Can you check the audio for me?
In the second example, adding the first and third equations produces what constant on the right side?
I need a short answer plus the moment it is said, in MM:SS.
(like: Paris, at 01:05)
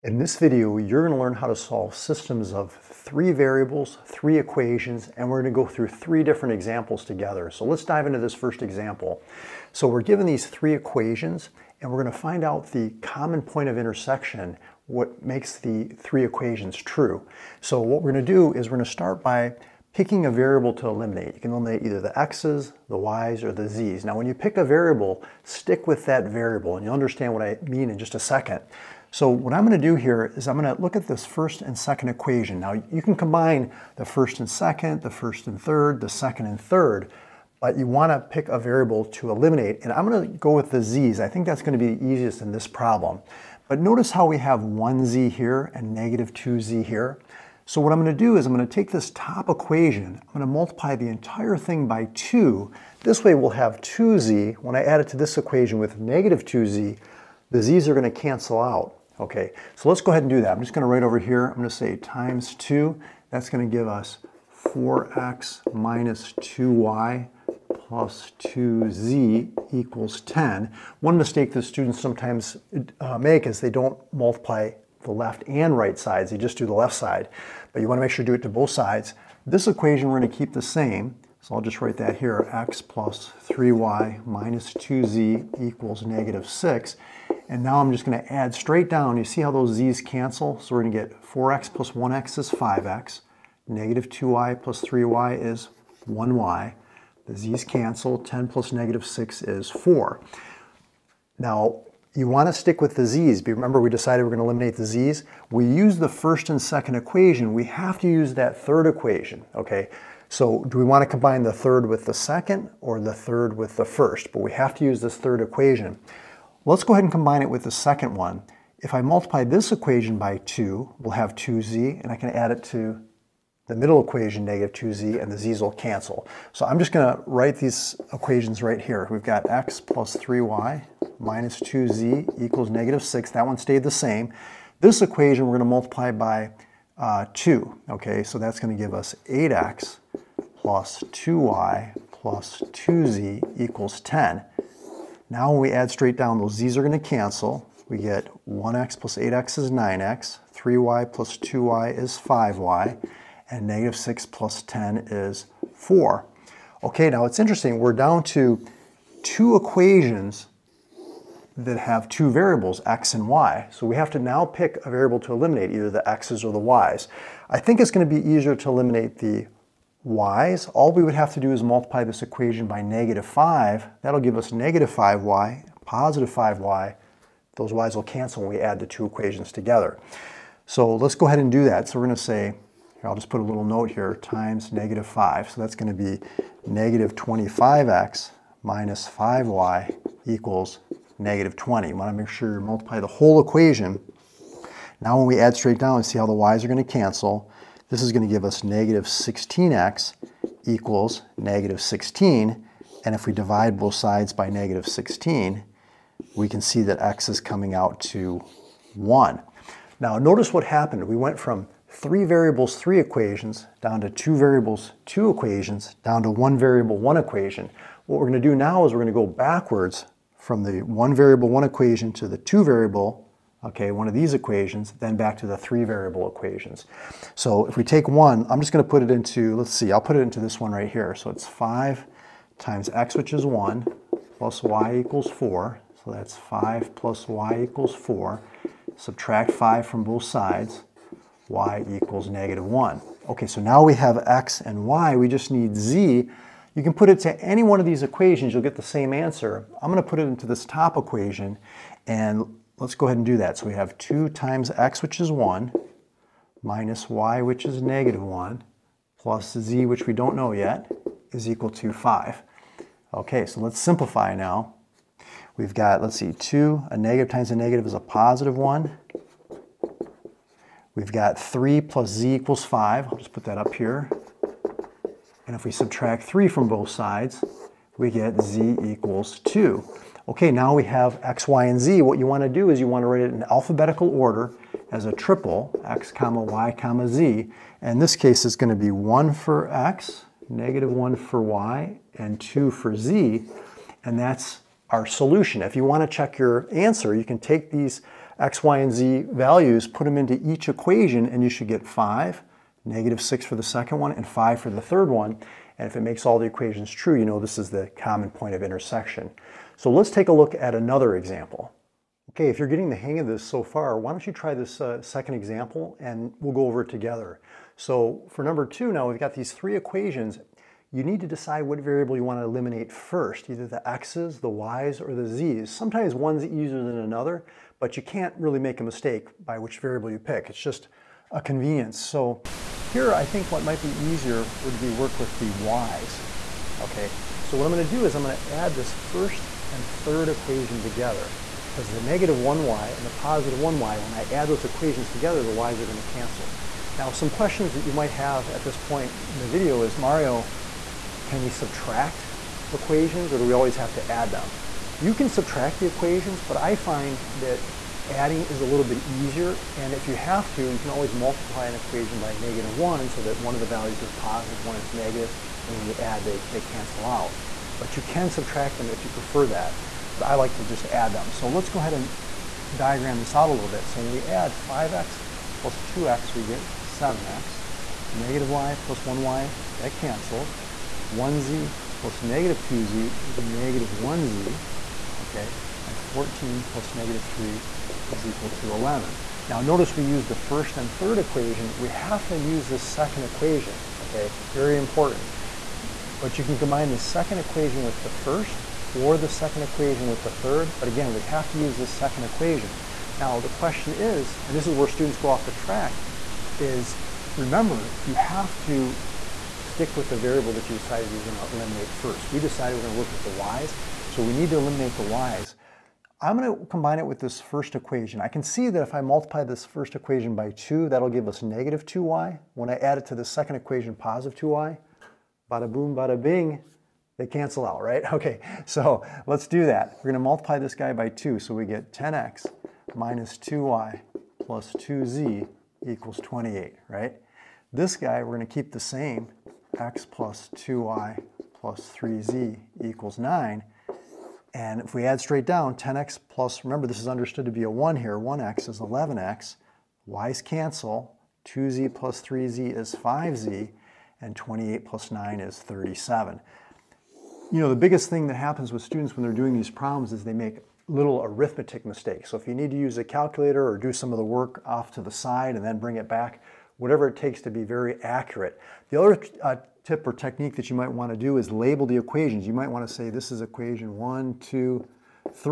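11, at 06:25.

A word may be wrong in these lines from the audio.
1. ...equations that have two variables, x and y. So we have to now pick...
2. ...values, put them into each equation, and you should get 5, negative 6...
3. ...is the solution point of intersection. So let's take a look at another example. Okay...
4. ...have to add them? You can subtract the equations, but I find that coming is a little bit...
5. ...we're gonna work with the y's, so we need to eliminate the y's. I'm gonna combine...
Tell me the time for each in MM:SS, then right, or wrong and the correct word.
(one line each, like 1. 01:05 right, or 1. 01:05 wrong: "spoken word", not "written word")
1. 02:39 right
2. 04:59 right
3. 05:07 wrong: "common", not "solution"
4. 05:53 wrong: "adding", not "coming"
5. 06:52 right.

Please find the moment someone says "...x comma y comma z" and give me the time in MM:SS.
04:45.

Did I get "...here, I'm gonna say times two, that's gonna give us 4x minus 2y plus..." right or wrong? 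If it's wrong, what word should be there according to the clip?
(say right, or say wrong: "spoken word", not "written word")
right.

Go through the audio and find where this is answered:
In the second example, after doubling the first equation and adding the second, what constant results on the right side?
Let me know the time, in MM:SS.
07:34.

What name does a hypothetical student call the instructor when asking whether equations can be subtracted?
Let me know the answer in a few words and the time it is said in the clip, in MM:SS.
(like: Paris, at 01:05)
Mario, at 05:49.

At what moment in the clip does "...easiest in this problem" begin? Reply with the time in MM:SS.
00:42.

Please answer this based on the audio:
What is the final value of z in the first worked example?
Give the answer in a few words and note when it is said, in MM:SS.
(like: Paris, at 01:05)
2, at 04:38.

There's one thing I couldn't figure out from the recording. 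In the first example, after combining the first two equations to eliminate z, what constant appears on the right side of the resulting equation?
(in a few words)
4.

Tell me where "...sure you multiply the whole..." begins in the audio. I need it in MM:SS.
03:12.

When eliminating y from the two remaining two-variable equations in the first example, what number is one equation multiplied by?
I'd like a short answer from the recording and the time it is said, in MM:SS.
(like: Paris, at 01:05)
-5, at 03:04.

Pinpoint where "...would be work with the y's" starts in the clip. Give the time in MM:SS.
05:34.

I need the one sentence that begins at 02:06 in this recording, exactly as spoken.
So I'm just going to write these equations right here.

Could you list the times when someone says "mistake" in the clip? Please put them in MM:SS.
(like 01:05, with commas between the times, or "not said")
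01:11, 05:28, 07:41.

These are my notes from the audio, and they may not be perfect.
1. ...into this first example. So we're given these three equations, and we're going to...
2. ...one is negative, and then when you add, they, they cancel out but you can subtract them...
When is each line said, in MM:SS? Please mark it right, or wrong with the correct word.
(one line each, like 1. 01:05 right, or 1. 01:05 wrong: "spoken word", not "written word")
1. 00:08 right
2. 06:04 right.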